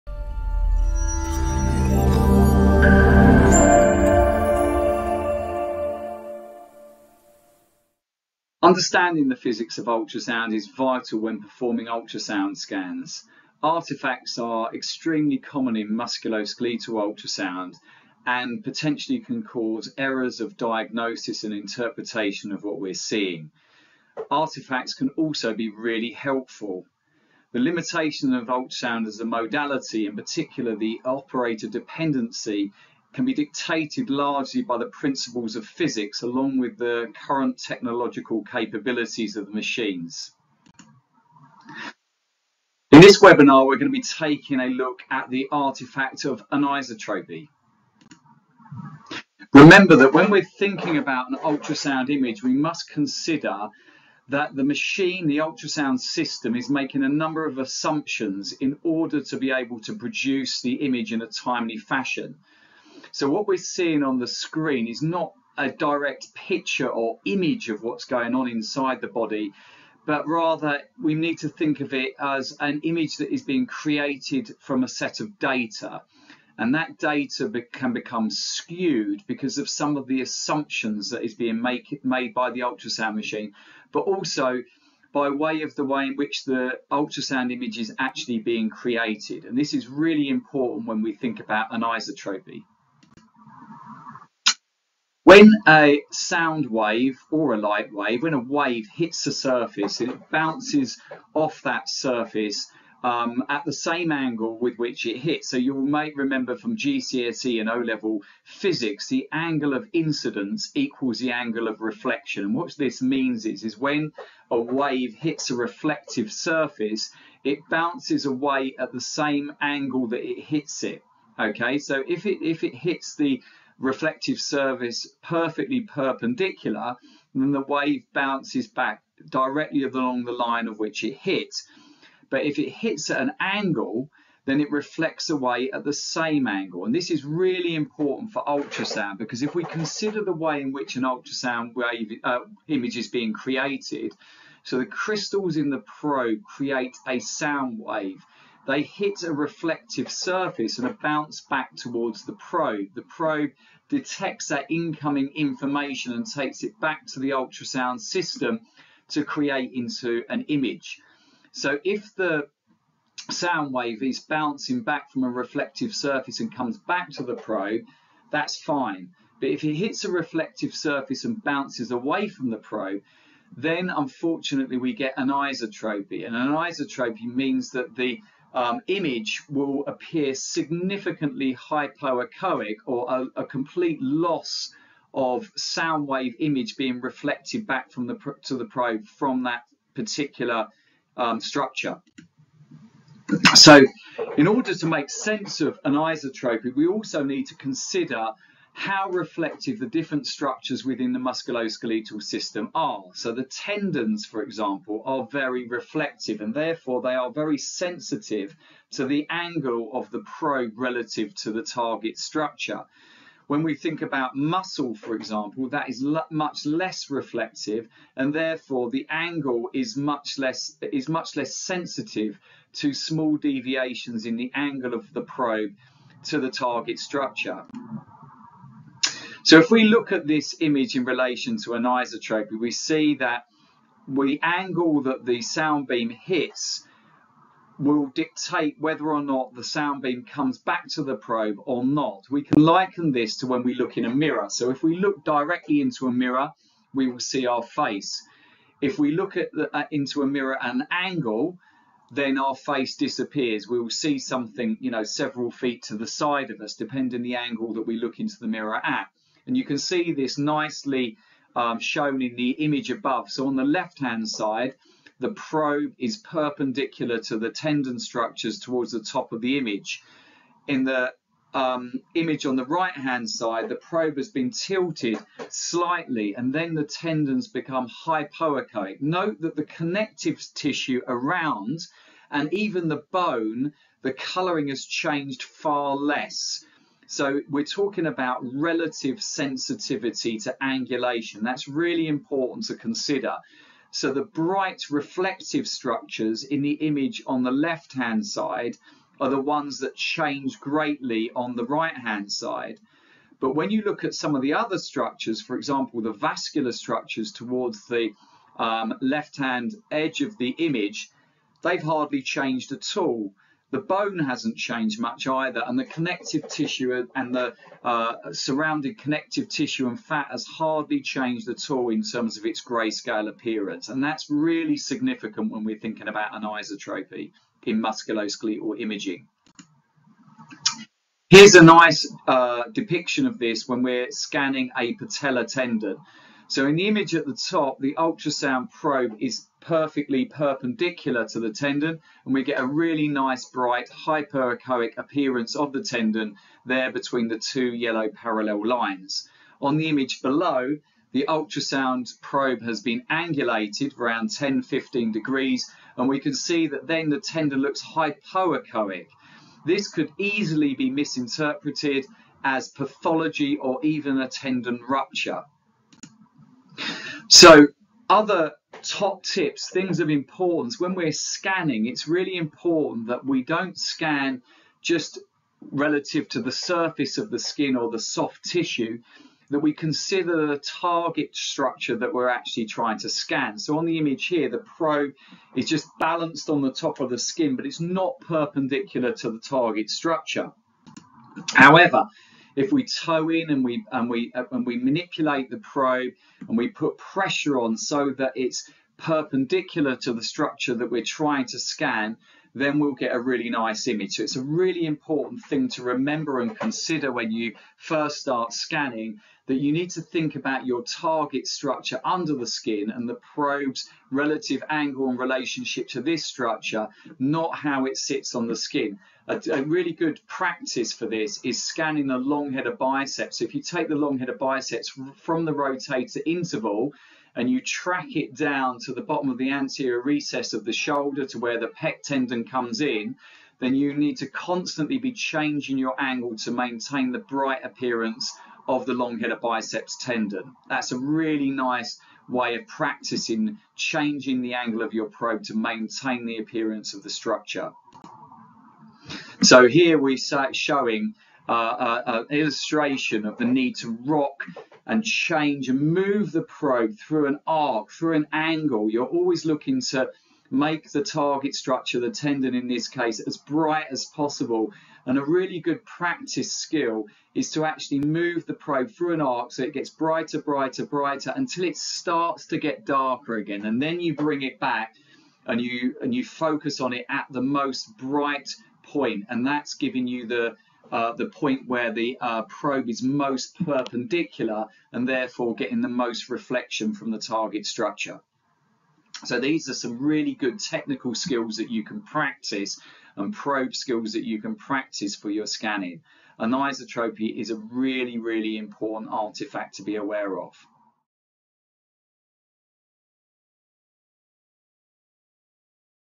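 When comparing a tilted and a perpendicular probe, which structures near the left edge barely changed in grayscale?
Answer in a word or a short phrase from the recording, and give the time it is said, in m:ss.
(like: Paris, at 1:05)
Vascular structures, at 5:06.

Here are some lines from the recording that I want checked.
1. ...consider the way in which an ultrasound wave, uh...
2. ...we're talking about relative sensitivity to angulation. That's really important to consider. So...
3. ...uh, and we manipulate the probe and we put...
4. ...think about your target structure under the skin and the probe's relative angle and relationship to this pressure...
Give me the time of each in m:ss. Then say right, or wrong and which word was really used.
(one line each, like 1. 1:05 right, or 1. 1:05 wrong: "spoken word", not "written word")
1. 2:19 right
2. 4:47 right
3. 6:34 right
4. 6:50 wrong: "structure", not "pressure".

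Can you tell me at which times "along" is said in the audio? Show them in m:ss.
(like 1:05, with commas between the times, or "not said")
0:36, 2:09.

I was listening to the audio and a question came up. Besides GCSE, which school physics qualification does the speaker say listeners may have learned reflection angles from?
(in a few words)
O-level.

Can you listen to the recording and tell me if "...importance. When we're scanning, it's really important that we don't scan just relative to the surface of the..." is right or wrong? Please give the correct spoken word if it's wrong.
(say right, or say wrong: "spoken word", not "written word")
right.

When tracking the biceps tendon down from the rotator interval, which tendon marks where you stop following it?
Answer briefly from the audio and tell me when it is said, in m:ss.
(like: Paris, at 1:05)
Pec tendon, at 7:11.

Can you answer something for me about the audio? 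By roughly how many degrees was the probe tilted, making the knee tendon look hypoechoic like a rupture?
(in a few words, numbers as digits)
10-15 degrees.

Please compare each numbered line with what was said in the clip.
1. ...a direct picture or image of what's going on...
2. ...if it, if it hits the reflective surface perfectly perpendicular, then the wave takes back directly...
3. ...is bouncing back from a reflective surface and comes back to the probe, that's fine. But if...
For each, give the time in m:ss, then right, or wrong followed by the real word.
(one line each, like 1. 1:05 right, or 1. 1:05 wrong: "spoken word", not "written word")
1. 1:05 right
2. 2:02 wrong: "bounces", not "takes"
3. 2:44 right.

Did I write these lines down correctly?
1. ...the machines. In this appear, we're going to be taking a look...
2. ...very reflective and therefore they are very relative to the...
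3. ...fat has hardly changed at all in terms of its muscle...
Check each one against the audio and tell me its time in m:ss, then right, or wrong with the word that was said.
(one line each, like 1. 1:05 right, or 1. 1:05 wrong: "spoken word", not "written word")
1. 0:39 wrong: "webinar", not "appear"
2. 3:25 wrong: "sensitive", not "relative"
3. 5:19 wrong: "grayscale", not "muscle".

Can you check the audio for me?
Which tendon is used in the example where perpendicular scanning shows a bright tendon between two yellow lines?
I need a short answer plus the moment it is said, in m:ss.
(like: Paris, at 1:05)
Patella tendon, at 5:34.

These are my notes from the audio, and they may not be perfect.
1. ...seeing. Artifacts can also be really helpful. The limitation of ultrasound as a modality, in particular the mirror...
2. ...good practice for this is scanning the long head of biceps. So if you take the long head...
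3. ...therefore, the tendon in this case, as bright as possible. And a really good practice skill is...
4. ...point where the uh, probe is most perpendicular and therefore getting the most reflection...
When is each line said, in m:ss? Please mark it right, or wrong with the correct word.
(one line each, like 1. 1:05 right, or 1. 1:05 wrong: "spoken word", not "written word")
1. 0:22 wrong: "operator", not "mirror"
2. 6:59 right
3. 7:41 wrong: "structure", not "therefore"
4. 8:01 right.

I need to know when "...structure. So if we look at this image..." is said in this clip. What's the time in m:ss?
3:46.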